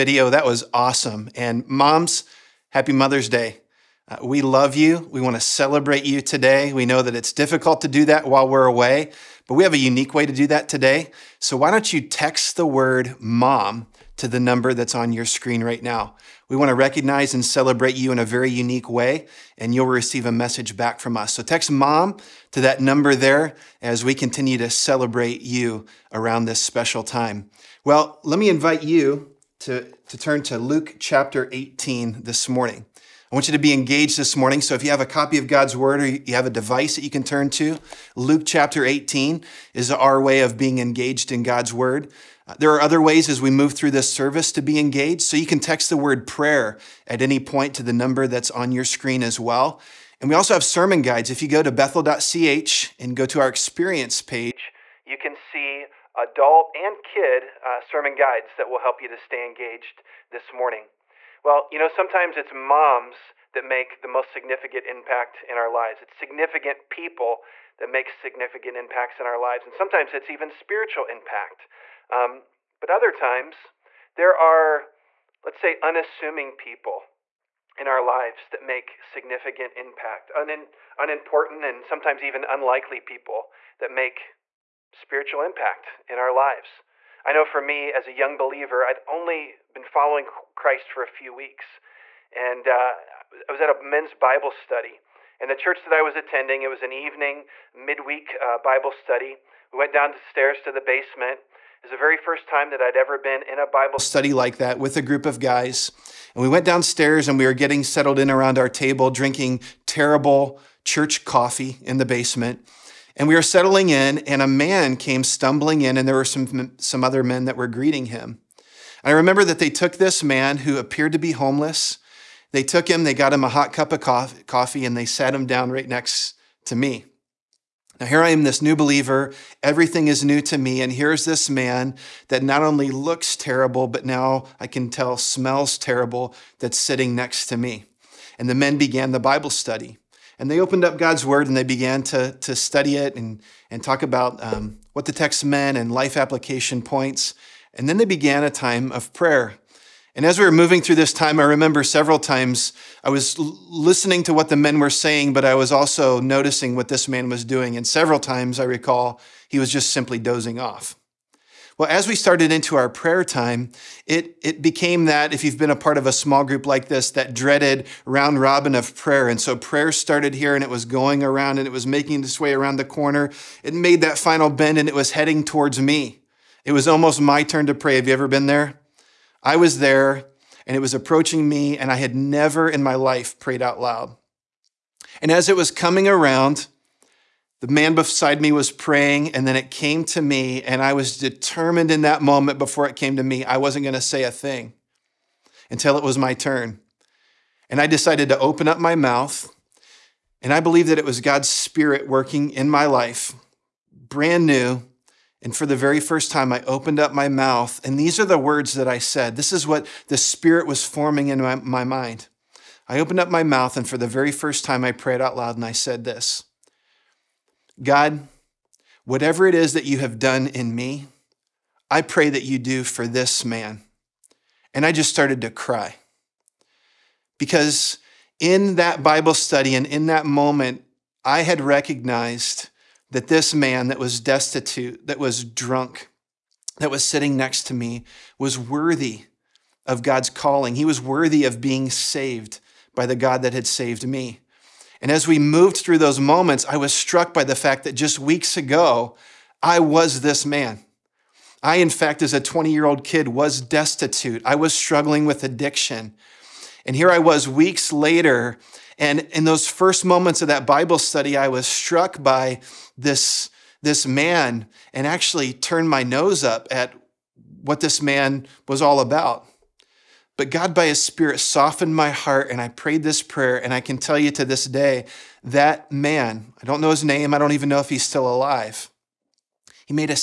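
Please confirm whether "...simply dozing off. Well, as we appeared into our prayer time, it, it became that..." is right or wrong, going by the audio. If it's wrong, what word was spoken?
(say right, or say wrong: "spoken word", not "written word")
wrong: "started", not "appeared".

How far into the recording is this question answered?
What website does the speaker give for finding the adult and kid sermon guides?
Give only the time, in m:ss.
0:51.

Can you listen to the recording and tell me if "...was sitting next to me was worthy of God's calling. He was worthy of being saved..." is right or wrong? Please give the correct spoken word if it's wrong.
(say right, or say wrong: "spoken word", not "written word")
right.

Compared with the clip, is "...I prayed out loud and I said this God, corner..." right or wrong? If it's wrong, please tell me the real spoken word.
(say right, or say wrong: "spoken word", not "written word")
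wrong: "whatever", not "corner".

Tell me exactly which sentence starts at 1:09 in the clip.
And sometimes it's even spiritual impact.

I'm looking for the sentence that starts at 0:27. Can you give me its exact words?
Well, let me invite you to, to turn to Luke chapter 18 this morning.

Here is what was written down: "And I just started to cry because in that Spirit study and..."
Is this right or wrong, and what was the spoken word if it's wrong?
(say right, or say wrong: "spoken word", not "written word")
wrong: "Bible", not "Spirit".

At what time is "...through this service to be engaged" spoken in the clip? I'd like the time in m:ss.
0:43.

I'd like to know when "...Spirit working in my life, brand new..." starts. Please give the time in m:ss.
3:21.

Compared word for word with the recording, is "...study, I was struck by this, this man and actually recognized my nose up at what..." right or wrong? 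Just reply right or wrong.
wrong.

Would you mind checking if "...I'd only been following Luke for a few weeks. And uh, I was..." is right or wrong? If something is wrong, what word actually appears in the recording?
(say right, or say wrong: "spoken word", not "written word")
wrong: "Christ", not "Luke".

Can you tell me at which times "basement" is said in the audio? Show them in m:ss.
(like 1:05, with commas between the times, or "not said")
1:40, 1:52.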